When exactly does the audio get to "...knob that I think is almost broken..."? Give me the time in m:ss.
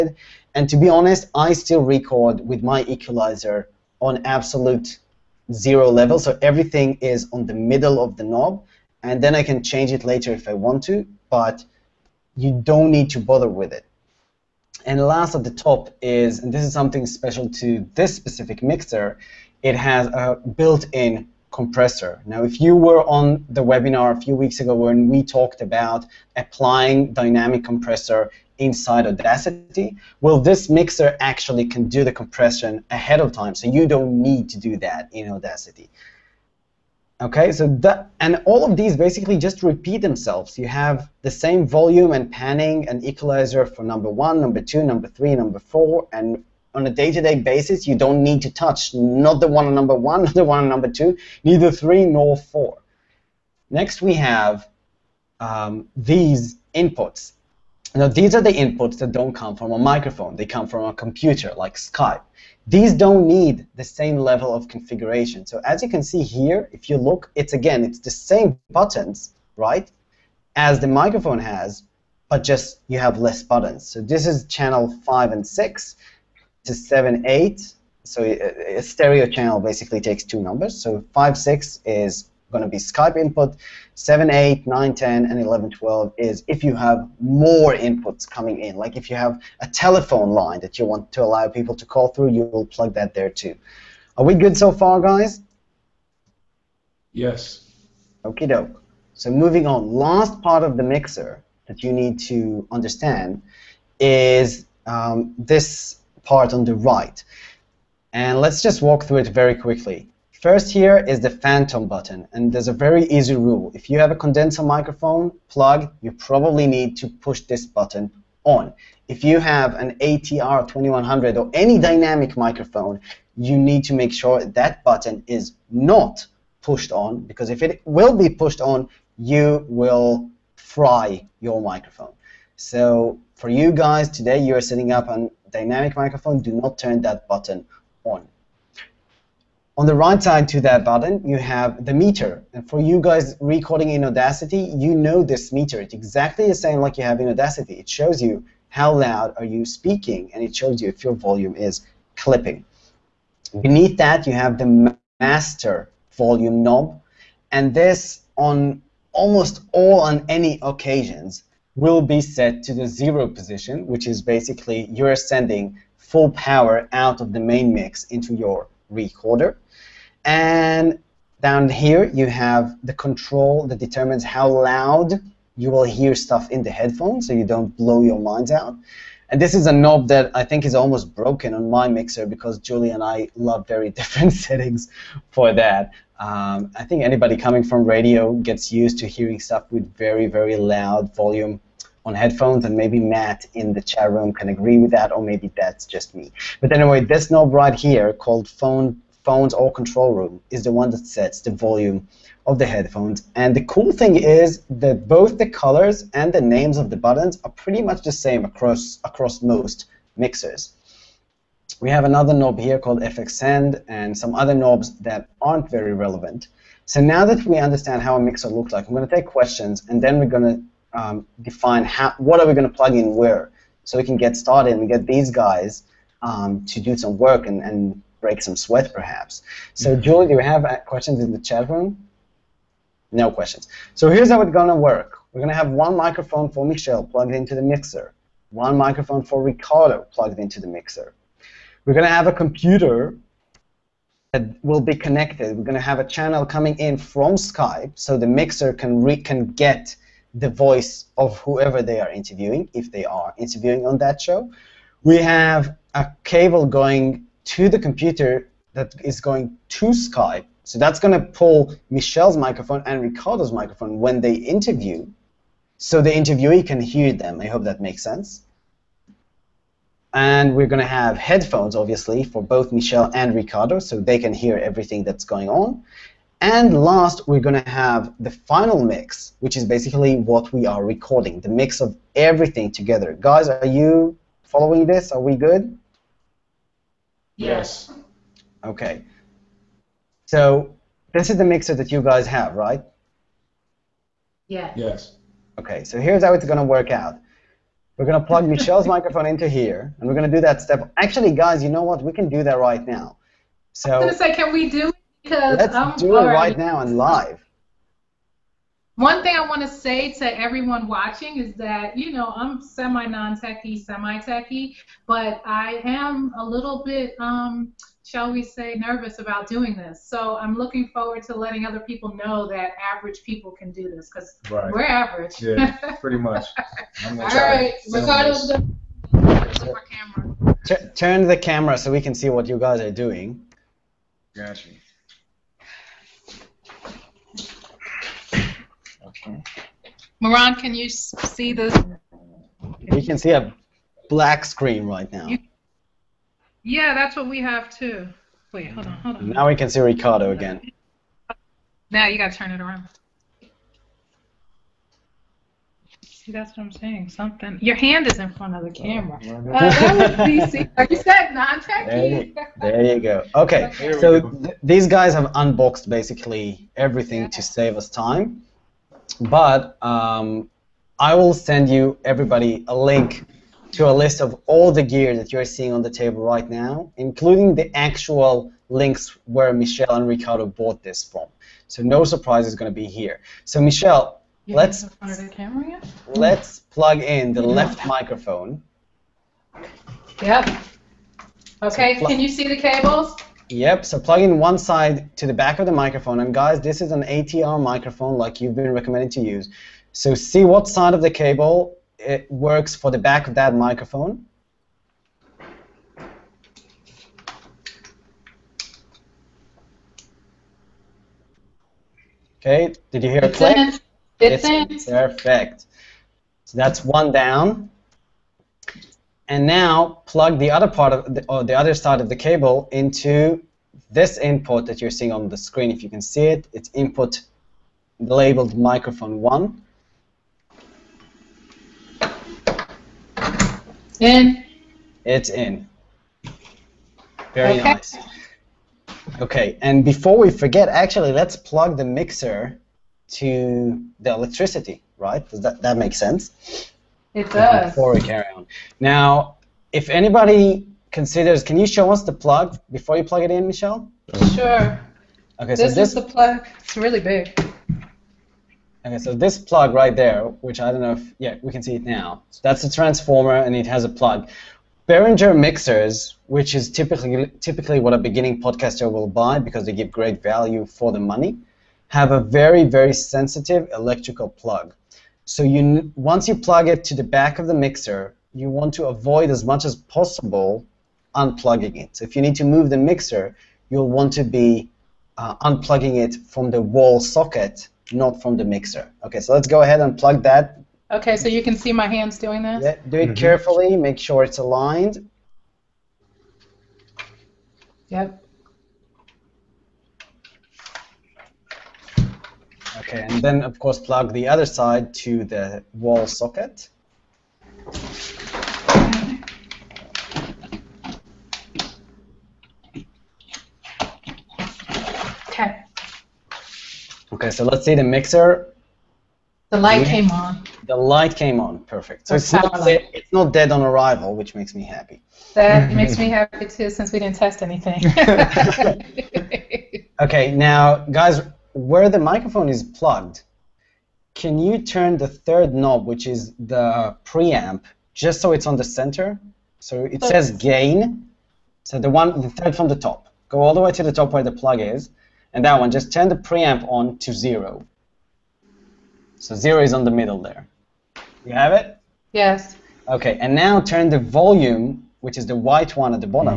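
2:59.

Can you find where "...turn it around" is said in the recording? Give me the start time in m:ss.
5:52.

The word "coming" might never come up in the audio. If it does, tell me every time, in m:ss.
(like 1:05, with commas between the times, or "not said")
1:28, 3:07, 4:06.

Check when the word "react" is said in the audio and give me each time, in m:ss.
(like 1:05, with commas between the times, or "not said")
not said.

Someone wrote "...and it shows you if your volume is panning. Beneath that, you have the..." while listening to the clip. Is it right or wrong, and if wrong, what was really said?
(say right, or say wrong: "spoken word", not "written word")
wrong: "clipping", not "panning".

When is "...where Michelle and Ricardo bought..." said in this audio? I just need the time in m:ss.
6:19.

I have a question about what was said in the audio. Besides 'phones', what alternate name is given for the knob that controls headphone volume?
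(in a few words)
Control room.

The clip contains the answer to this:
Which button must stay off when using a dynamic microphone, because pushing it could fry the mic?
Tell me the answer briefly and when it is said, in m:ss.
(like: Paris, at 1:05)
Phantom button, at 1:51.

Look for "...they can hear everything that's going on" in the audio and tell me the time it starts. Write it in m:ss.
4:33.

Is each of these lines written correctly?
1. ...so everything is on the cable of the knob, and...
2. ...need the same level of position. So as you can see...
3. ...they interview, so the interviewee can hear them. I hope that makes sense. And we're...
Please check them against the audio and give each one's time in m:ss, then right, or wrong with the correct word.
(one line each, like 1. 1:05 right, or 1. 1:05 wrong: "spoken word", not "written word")
1. 0:06 wrong: "middle", not "cable"
2. 1:03 wrong: "configuration", not "position"
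3. 4:24 right.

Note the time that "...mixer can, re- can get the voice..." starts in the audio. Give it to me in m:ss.
4:08.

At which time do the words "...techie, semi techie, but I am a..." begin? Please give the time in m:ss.
5:13.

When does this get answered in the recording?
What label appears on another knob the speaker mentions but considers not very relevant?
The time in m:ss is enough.
3:33.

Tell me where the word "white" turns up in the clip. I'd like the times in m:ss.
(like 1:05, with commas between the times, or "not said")
9:15.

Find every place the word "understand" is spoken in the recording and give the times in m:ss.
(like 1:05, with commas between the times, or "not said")
1:42, 3:37.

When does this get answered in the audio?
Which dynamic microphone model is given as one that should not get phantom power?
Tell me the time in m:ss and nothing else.
1:59.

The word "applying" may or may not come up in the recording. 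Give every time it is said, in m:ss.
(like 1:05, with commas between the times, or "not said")
0:26.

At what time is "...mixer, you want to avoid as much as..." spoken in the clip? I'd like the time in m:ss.
7:57.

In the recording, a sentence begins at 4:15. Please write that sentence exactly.
We have a cable going to the computer that is going to Skype.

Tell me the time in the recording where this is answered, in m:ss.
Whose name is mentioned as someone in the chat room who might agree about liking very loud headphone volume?
3:12.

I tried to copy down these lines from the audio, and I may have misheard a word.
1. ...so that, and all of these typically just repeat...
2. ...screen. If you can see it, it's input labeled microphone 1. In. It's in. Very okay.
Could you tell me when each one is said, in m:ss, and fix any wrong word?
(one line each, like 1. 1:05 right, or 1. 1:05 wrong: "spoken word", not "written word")
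1. 0:37 wrong: "basically", not "typically"
2. 7:05 right.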